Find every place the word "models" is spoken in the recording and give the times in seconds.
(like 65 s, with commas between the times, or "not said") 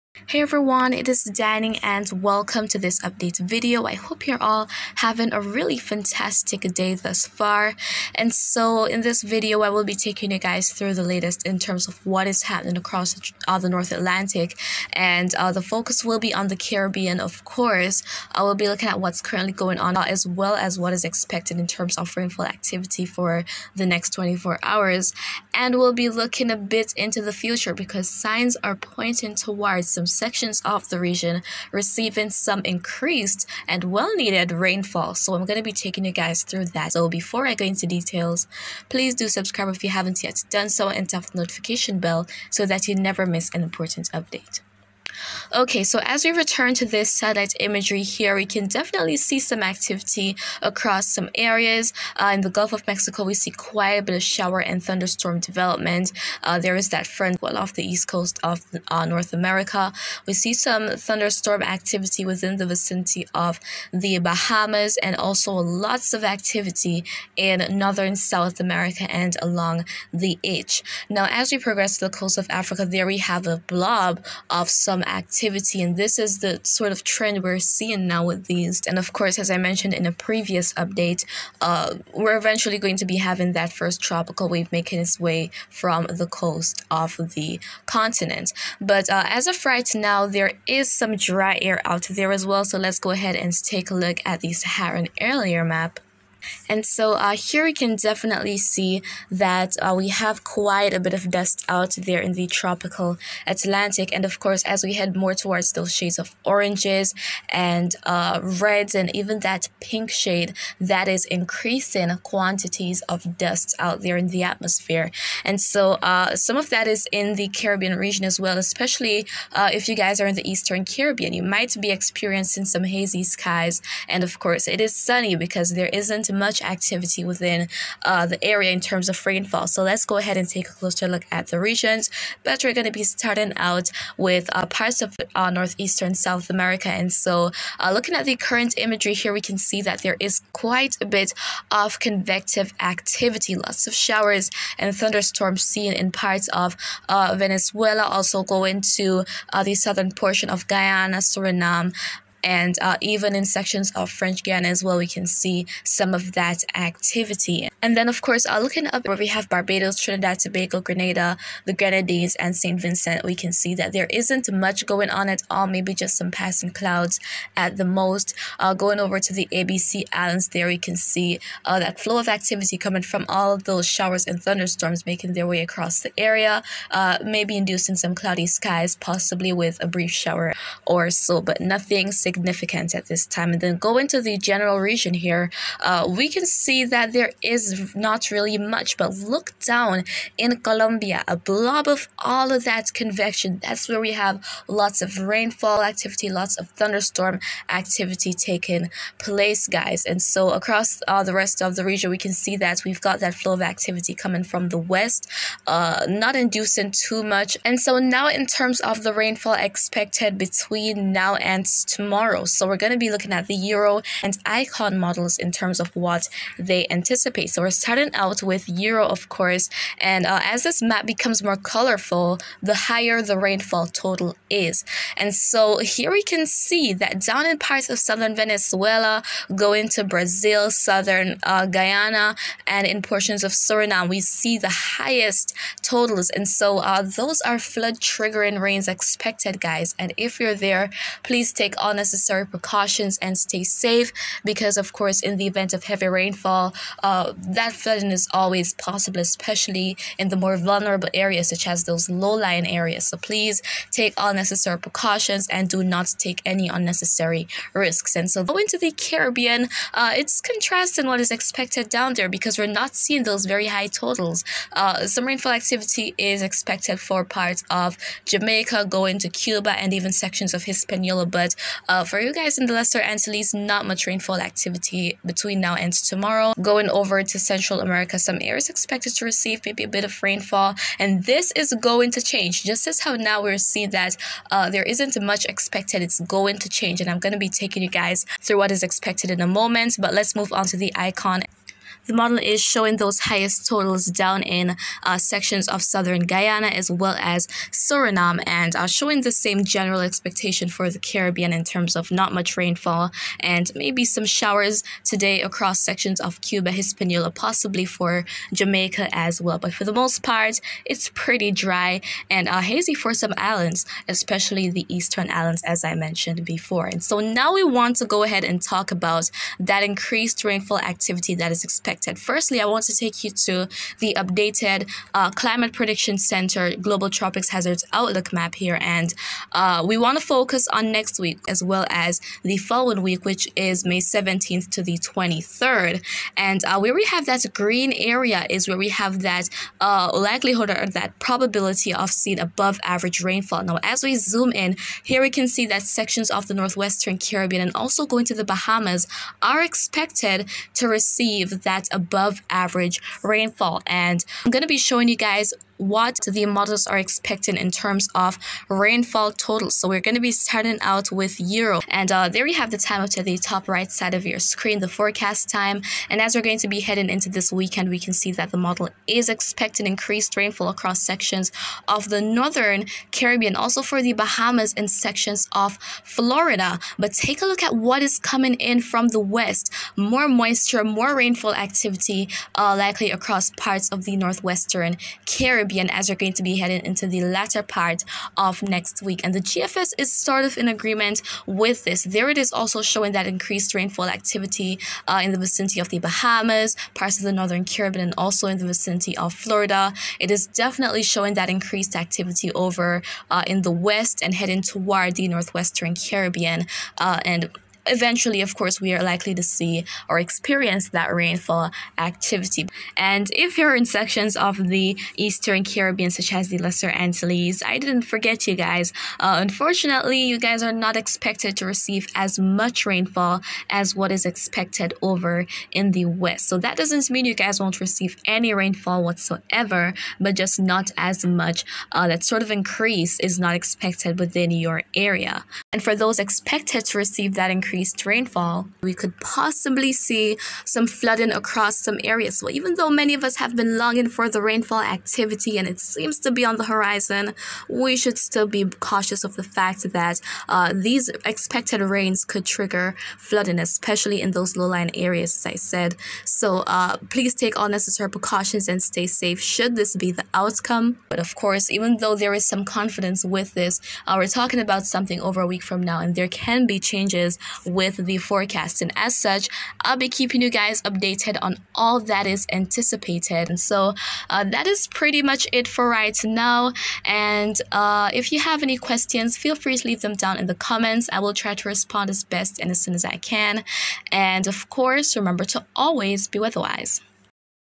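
214 s, 292 s, 356 s, 368 s.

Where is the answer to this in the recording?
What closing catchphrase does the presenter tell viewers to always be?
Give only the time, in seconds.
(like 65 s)
486 s.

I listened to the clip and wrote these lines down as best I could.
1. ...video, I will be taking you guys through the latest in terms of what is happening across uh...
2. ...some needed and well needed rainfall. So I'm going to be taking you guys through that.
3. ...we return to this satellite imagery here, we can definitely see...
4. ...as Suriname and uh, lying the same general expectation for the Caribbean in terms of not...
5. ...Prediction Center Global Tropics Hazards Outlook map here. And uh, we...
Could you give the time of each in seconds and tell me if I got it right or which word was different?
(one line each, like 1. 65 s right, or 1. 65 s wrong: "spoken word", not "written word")
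1. 9 s right
2. 32 s wrong: "increased", not "needed"
3. 46 s right
4. 297 s wrong: "showing", not "lying"
5. 325 s right.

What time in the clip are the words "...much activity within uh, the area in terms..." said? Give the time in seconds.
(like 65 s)
126 s.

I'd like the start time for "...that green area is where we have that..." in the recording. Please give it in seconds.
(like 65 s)
337 s.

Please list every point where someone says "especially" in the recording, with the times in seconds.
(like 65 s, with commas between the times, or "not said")
118 s, 249 s, 314 s, 453 s.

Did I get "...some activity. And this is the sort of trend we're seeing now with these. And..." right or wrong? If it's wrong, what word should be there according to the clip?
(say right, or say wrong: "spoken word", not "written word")
right.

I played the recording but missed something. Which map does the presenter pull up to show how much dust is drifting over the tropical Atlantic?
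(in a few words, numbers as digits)
Saharan air layer map.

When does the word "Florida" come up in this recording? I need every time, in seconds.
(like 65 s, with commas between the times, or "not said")
376 s, 399 s.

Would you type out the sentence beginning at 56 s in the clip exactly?
Uh, there is that front well off the east coast of uh, North America.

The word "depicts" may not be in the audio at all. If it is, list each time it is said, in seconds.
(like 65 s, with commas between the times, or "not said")
not said.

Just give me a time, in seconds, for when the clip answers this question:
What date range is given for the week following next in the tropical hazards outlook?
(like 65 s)
333 s.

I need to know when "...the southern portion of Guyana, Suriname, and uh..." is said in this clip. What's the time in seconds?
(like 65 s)
149 s.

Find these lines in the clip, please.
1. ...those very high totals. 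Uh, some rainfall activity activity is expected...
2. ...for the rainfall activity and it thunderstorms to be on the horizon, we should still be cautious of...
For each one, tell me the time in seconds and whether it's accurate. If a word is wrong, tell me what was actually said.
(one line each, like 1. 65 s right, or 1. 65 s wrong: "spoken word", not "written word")
1. 263 s right
2. 444 s wrong: "seems", not "thunderstorms".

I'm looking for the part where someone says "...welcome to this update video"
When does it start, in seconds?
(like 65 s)
2 s.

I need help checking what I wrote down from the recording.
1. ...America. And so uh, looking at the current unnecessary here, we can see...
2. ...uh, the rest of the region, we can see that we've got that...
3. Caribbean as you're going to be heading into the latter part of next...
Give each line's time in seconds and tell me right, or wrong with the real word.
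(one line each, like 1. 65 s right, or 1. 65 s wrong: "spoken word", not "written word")
1. 136 s wrong: "imagery", not "unnecessary"
2. 201 s right
3. 385 s right.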